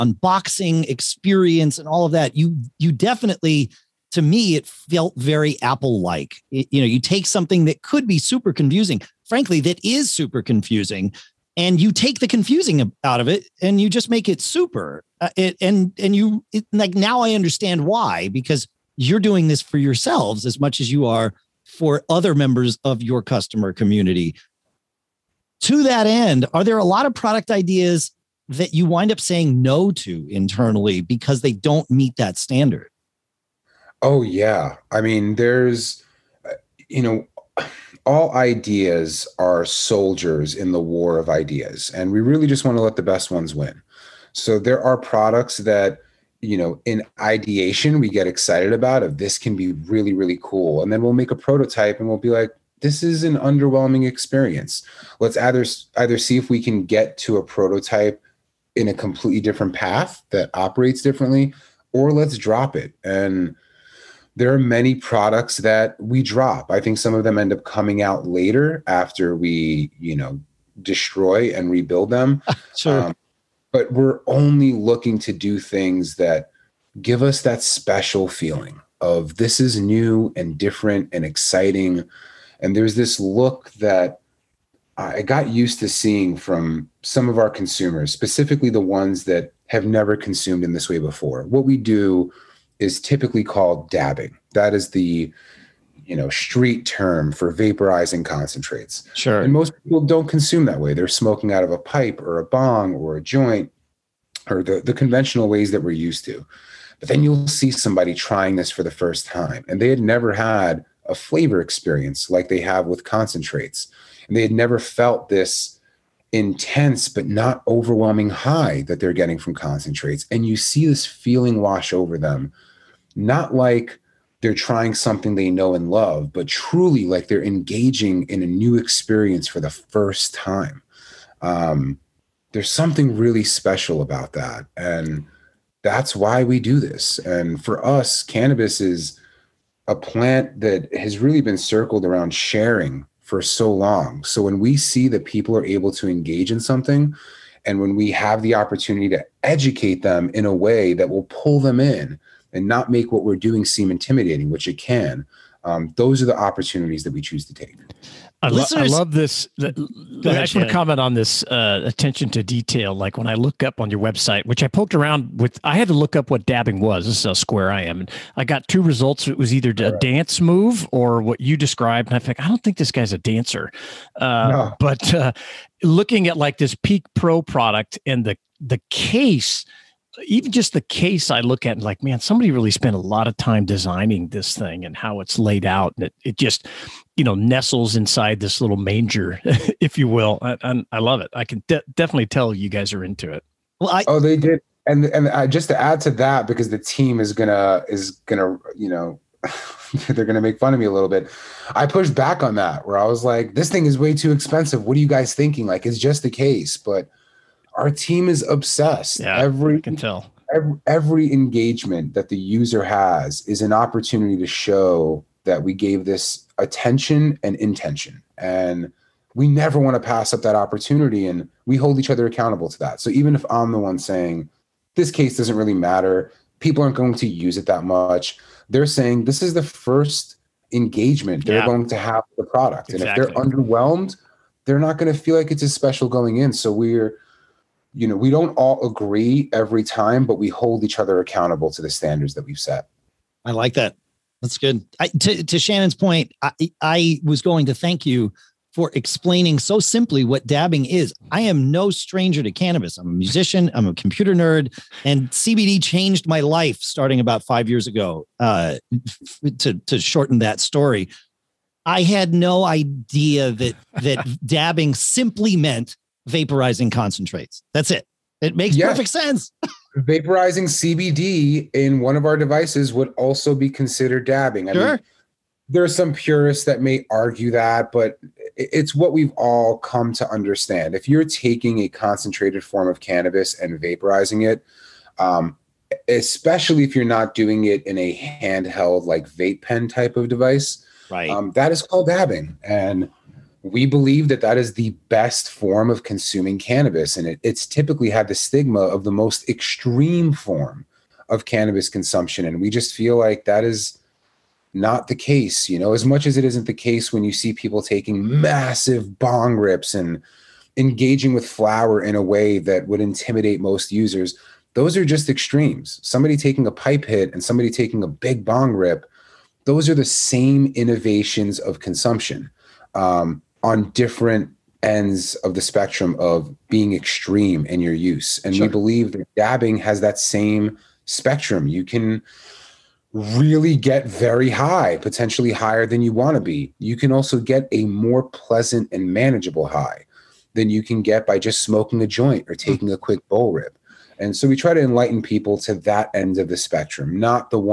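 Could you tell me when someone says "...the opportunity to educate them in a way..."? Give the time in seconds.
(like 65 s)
148 s.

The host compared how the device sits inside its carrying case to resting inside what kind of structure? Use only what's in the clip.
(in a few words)
manger.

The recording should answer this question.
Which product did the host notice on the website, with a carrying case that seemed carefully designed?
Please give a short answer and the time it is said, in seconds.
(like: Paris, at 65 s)
Peak Pro, at 176 s.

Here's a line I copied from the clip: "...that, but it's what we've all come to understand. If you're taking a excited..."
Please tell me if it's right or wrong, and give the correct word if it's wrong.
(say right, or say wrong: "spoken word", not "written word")
wrong: "concentrated", not "excited".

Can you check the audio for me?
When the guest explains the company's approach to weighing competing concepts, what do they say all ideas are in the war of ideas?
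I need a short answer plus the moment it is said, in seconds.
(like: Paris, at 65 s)
soldiers, at 39 s.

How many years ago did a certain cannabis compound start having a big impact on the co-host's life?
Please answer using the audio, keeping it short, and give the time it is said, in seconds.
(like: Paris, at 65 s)
5 years, at 257 s.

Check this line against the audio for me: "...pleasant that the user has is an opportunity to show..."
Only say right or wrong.
wrong.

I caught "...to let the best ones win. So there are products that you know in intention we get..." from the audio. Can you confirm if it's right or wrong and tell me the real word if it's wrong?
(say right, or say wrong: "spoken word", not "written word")
wrong: "ideation", not "intention".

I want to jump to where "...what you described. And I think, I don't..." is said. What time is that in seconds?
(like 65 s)
171 s.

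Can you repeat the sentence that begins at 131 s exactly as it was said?
Um, there's something really special about that.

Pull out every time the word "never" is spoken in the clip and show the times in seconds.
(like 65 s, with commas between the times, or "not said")
89 s, 109 s, 114 s, 219 s.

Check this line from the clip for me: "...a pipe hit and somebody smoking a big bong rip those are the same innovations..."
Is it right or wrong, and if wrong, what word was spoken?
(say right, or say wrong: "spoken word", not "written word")
wrong: "taking", not "smoking".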